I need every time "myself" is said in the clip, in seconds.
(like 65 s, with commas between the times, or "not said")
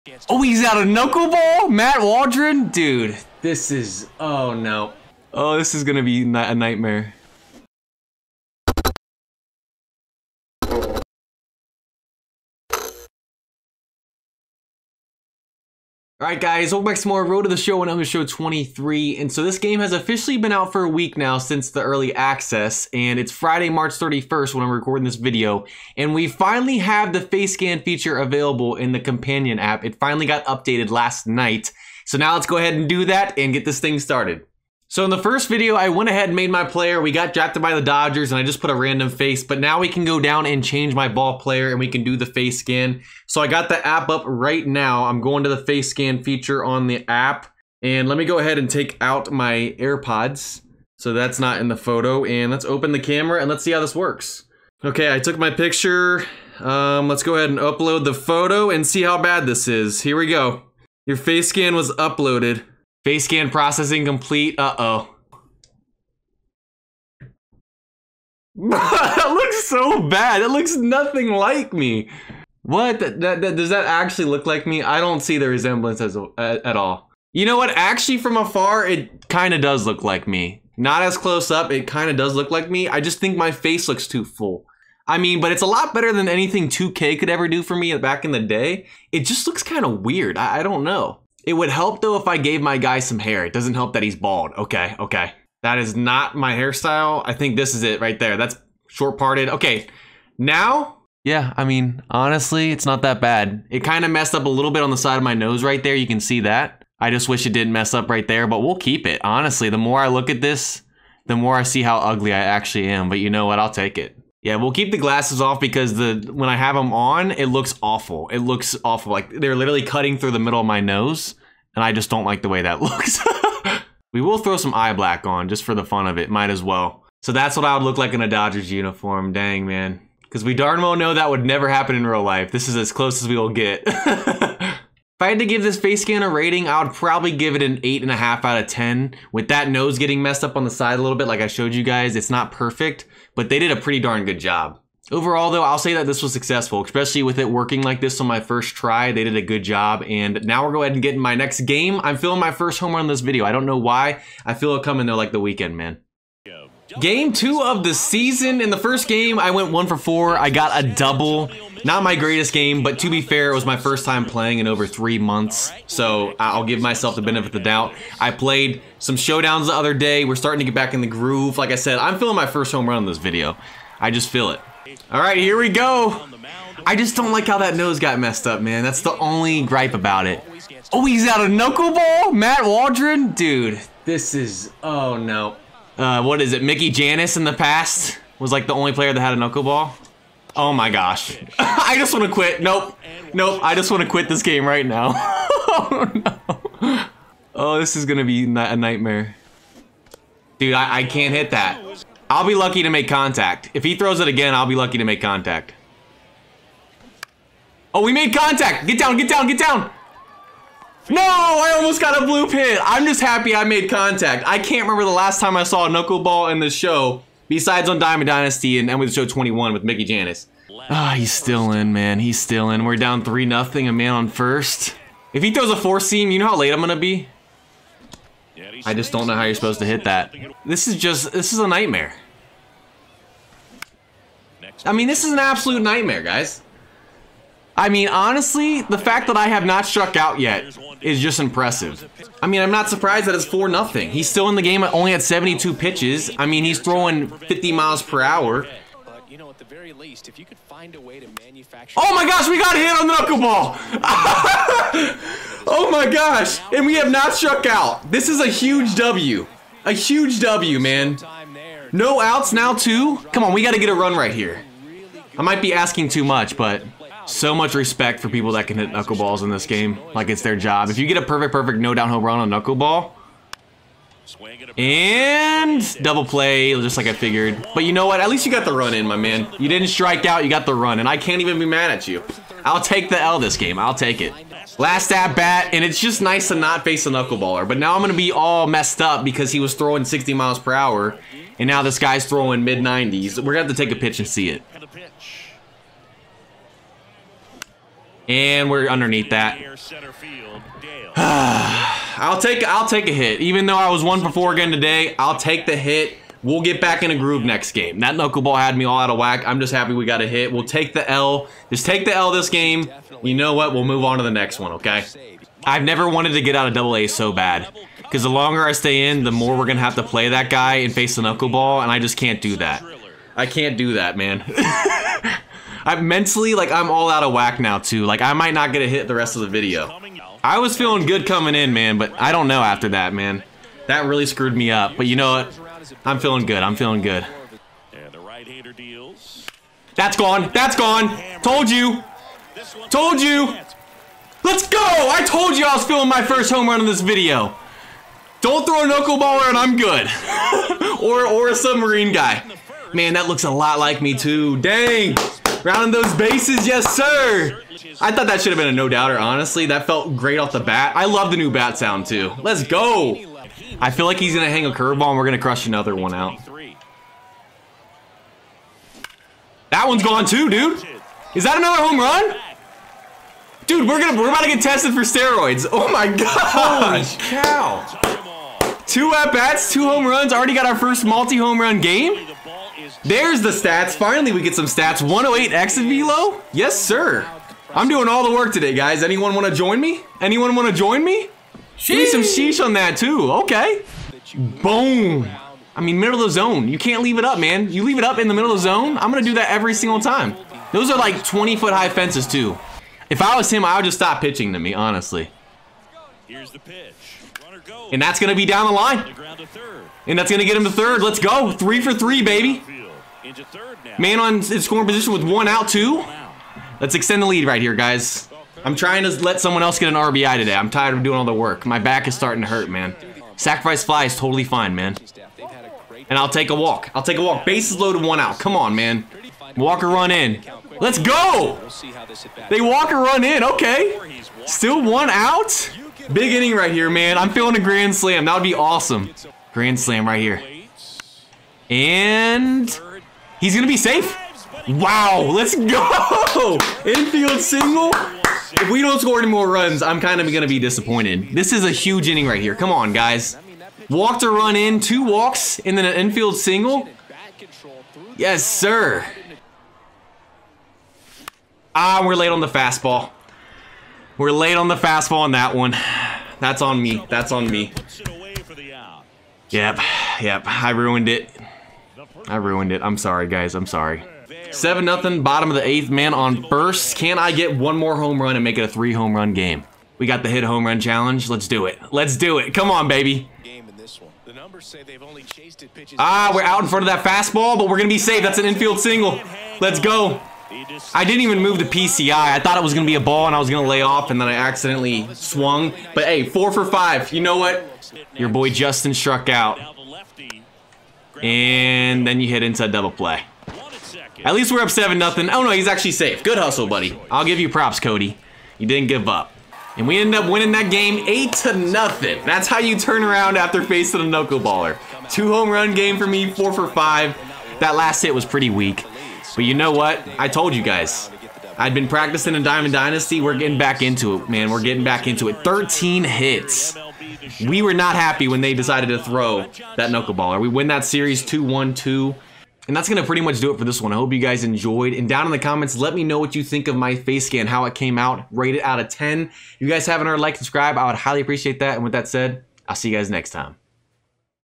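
166 s.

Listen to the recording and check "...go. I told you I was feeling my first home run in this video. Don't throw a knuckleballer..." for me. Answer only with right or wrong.
right.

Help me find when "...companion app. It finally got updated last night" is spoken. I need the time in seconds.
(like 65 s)
28 s.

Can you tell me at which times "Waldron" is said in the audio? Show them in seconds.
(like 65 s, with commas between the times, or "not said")
2 s, 182 s.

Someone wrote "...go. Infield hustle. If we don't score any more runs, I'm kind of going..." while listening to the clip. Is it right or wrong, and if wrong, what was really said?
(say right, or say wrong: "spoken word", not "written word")
wrong: "single", not "hustle".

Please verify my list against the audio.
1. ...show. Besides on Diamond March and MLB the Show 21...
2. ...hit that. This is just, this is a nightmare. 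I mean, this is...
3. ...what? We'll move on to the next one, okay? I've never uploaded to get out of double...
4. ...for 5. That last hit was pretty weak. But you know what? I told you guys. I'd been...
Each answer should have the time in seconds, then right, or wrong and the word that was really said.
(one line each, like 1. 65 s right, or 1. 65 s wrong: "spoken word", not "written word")
1. 216 s wrong: "Dynasty", not "March"
2. 229 s right
3. 313 s wrong: "wanted", not "uploaded"
4. 516 s right.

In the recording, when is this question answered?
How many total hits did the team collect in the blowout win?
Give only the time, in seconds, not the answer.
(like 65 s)
525 s.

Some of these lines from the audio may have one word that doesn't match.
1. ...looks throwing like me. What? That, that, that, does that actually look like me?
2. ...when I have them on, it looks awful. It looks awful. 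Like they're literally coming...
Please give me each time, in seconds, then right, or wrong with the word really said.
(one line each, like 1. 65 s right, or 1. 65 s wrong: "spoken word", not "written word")
1. 70 s wrong: "nothing", not "throwing"
2. 116 s wrong: "cutting", not "coming".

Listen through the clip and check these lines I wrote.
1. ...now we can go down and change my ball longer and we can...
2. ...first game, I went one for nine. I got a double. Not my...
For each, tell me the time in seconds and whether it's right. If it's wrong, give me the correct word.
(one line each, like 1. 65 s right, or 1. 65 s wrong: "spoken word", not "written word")
1. 39 s wrong: "player", not "longer"
2. 158 s wrong: "four", not "nine".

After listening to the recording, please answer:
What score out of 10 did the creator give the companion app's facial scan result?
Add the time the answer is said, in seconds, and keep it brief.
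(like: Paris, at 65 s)
8.5, at 137 s.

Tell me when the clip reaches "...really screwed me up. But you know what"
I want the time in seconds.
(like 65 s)
334 s.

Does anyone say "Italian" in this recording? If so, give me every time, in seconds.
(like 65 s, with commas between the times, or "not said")
not said.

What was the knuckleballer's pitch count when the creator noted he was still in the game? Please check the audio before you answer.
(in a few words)
72.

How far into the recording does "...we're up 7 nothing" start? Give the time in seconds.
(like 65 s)
504 s.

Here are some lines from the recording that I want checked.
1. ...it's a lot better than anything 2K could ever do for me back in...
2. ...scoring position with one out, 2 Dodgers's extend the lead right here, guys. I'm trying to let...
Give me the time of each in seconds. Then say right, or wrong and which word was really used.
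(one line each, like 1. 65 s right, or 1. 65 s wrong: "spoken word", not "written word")
1. 85 s right
2. 414 s wrong: "Let", not "Dodgers".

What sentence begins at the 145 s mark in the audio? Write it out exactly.
Overall, though, I'll say that this was successful, especially with it working like this on my first try.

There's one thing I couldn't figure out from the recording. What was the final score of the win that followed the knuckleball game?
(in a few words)
8 to 0.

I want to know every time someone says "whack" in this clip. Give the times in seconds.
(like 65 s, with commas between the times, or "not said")
309 s, 327 s.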